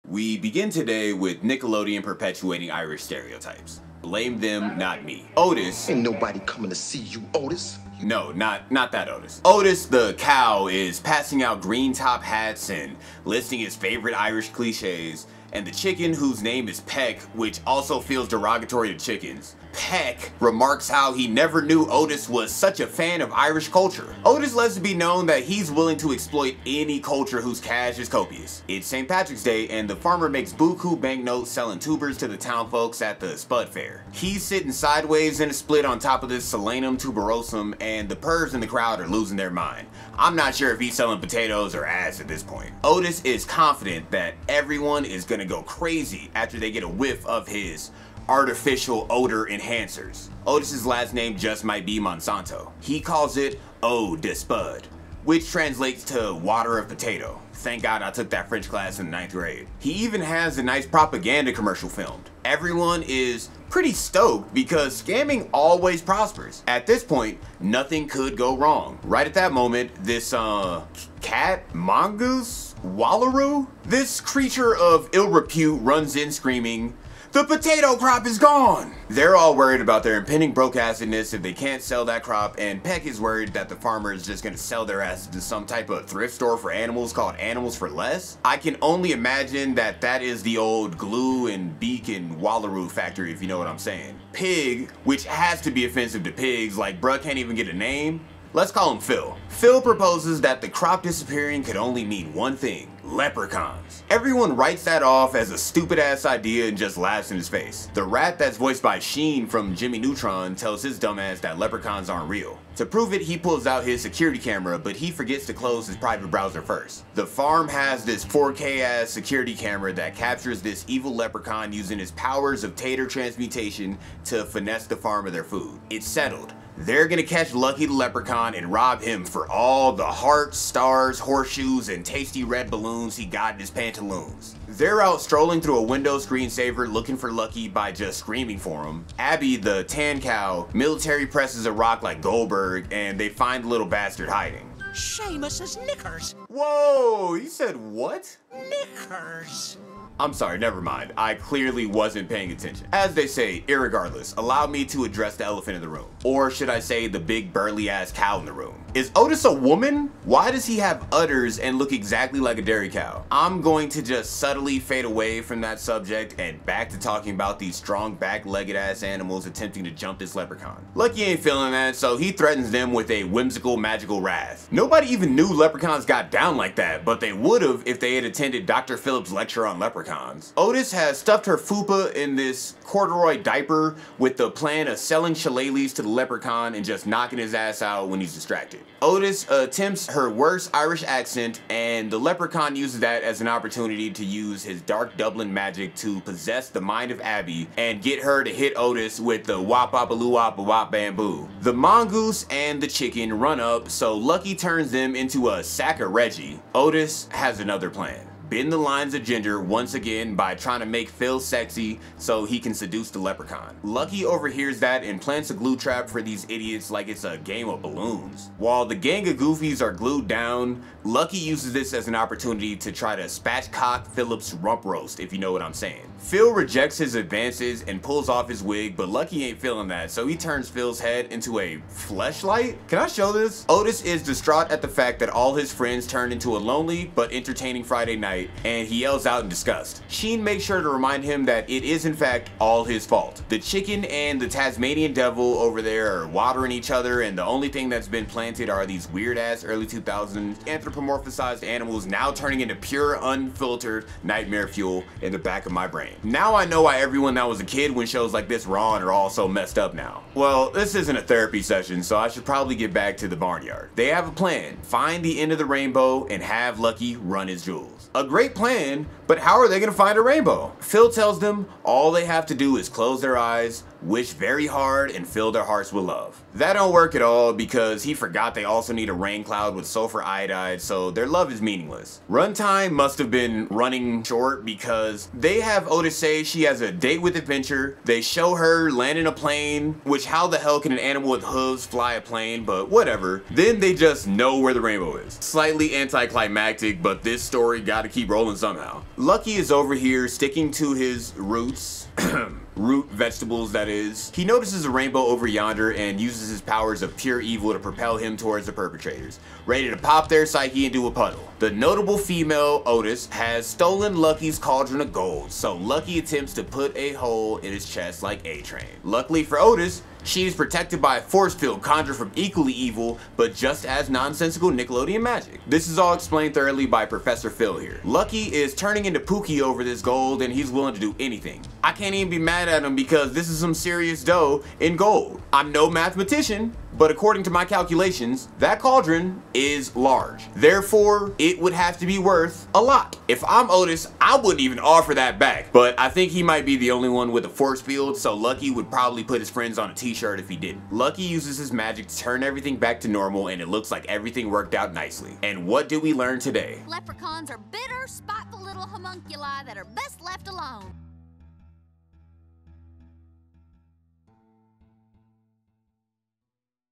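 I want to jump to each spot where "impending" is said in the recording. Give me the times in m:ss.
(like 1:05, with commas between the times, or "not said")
1:20.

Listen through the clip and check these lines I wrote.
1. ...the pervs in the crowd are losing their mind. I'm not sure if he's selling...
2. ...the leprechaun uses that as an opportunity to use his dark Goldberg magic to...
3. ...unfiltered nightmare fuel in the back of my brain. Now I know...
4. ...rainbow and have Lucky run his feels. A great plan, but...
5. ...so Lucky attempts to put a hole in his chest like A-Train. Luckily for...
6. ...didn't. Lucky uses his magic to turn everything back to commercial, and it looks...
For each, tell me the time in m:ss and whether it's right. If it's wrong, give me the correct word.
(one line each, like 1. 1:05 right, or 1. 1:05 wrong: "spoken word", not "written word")
1. 0:38 right
2. 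3:12 wrong: "Dublin", not "Goldberg"
3. 4:13 right
4. 4:25 wrong: "jewels", not "feels"
5. 5:15 right
6. 5:50 wrong: "normal", not "commercial".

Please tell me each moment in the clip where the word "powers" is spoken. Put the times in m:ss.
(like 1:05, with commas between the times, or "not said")
2:02, 5:06.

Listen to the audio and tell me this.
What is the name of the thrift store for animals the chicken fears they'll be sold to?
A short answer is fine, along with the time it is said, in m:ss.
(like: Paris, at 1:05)
Animals for Less, at 1:27.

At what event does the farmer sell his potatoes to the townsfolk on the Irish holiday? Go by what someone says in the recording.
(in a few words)
Spud Fair.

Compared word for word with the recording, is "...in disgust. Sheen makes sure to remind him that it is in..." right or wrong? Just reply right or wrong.
right.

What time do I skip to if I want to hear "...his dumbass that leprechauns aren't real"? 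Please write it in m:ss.
1:50.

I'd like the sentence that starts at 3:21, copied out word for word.
The mongoose and the chicken run up so Lucky turns them into a sack of Reggie.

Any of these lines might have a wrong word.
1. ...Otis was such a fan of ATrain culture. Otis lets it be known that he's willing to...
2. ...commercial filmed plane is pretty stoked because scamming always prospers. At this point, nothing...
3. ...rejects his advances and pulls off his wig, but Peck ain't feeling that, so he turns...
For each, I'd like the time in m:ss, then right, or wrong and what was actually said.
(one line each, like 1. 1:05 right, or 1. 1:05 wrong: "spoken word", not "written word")
1. 0:21 wrong: "Irish", not "ATrain"
2. 1:01 wrong: "everyone", not "plane"
3. 3:46 wrong: "Lucky", not "Peck".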